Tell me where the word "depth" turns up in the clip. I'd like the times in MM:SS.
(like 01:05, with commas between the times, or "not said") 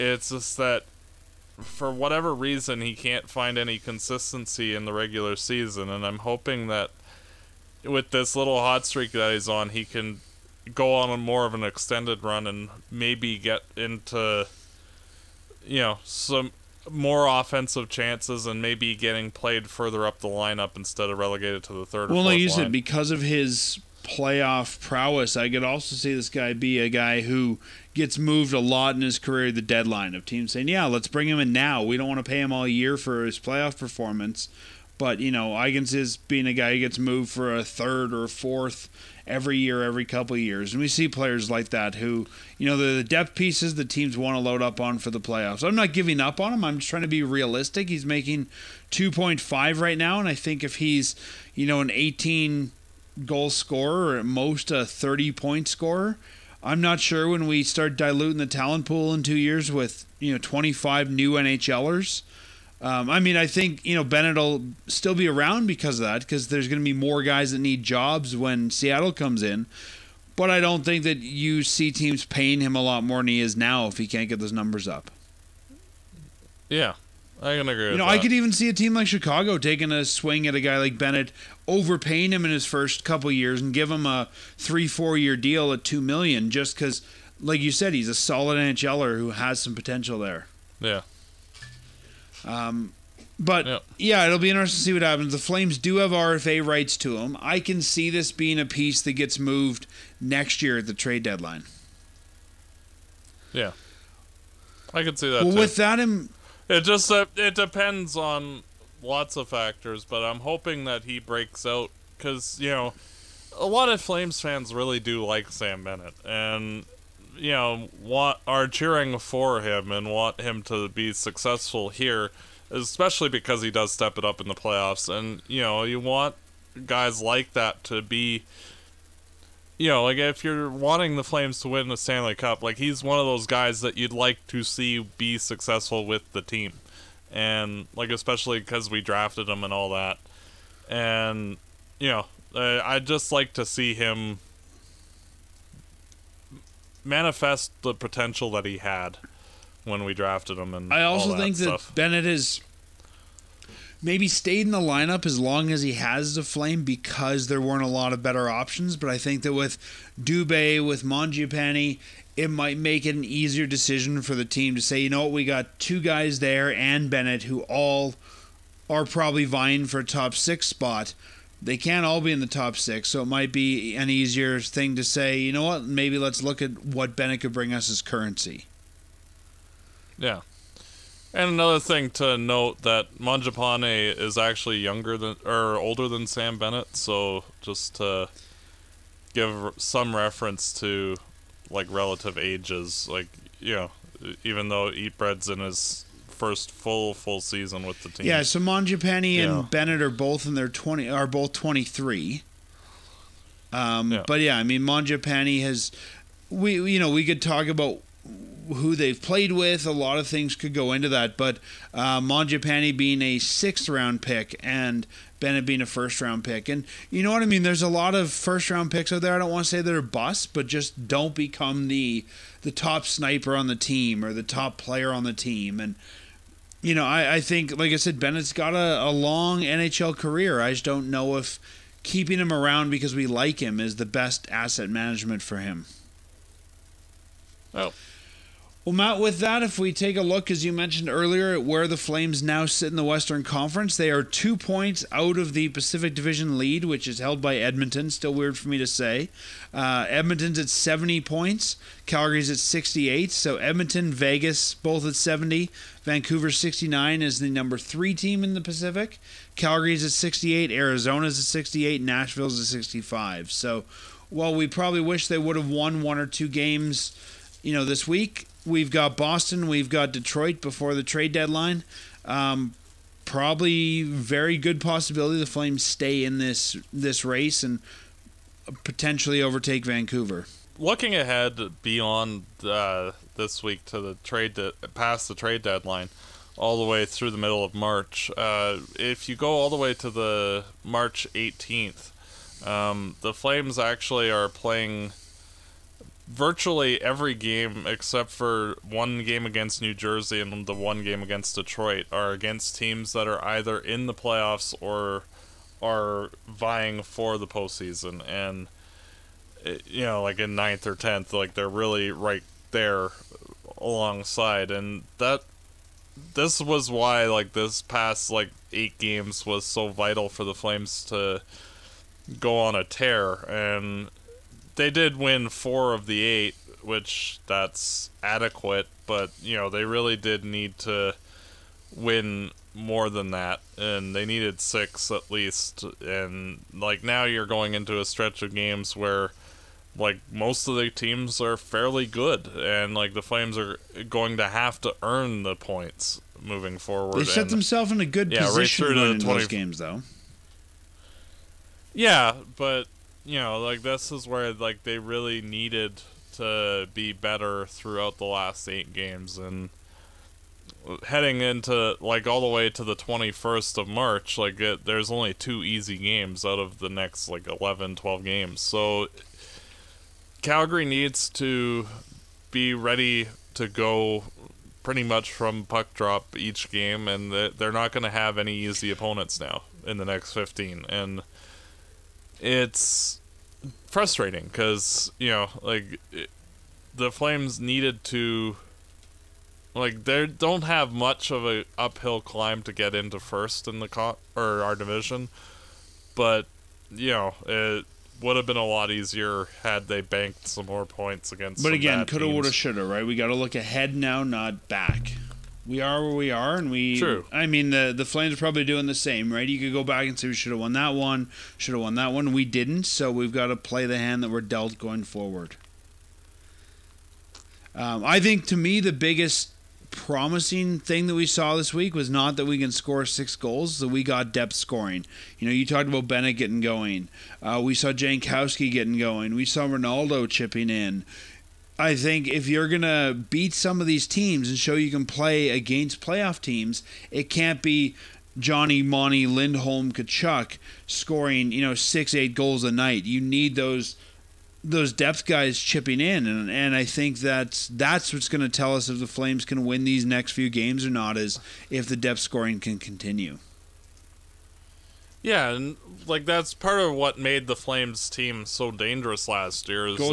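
00:43, 07:04, 07:24, 07:31.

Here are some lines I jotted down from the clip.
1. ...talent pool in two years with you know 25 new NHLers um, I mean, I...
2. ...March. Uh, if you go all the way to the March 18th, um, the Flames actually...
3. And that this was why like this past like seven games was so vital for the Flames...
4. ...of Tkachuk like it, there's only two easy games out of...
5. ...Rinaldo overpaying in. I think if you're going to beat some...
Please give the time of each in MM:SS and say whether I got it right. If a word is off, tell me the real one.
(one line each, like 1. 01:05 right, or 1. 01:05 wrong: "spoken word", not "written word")
1. 00:58 right
2. 04:47 right
3. 05:14 wrong: "eight", not "seven"
4. 06:03 wrong: "March", not "Tkachuk"
5. 07:09 wrong: "chipping", not "overpaying".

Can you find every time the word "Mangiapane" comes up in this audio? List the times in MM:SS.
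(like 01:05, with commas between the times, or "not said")
02:41, 03:03, 03:18, 03:24, 03:32.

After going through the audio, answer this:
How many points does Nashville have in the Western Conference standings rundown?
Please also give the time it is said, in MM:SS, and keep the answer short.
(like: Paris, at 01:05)
65, at 04:22.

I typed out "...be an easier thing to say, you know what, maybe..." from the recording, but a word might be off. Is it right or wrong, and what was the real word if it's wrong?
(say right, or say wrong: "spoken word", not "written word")
right.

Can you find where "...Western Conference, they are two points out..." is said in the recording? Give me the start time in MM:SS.
04:03.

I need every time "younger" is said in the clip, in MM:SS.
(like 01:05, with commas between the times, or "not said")
03:04.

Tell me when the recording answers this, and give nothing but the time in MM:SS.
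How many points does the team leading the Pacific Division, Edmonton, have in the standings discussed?
04:10.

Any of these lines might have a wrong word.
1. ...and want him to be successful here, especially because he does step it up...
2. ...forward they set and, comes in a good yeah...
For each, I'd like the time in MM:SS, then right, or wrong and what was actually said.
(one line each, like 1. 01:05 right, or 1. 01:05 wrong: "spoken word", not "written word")
1. 01:59 right
2. 05:46 wrong: "themselves", not "comes".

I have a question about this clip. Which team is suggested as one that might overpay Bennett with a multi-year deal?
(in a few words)
Chicago.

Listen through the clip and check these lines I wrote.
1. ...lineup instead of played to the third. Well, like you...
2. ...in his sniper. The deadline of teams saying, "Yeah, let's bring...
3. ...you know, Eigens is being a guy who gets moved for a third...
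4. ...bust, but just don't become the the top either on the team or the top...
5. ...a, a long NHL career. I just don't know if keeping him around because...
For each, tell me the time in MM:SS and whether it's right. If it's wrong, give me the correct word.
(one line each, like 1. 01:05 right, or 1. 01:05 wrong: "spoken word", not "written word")
1. 00:20 wrong: "relegated", not "played"
2. 00:28 wrong: "career", not "sniper"
3. 00:35 right
4. 03:40 wrong: "sniper", not "either"
5. 03:48 right.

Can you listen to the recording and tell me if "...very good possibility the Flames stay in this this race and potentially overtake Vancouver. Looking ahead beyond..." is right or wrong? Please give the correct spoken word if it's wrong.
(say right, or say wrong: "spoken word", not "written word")
right.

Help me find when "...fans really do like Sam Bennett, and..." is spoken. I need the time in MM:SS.
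01:54.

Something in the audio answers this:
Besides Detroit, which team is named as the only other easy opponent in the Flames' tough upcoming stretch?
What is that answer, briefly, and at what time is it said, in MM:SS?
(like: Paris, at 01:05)
New Jersey, at 04:59.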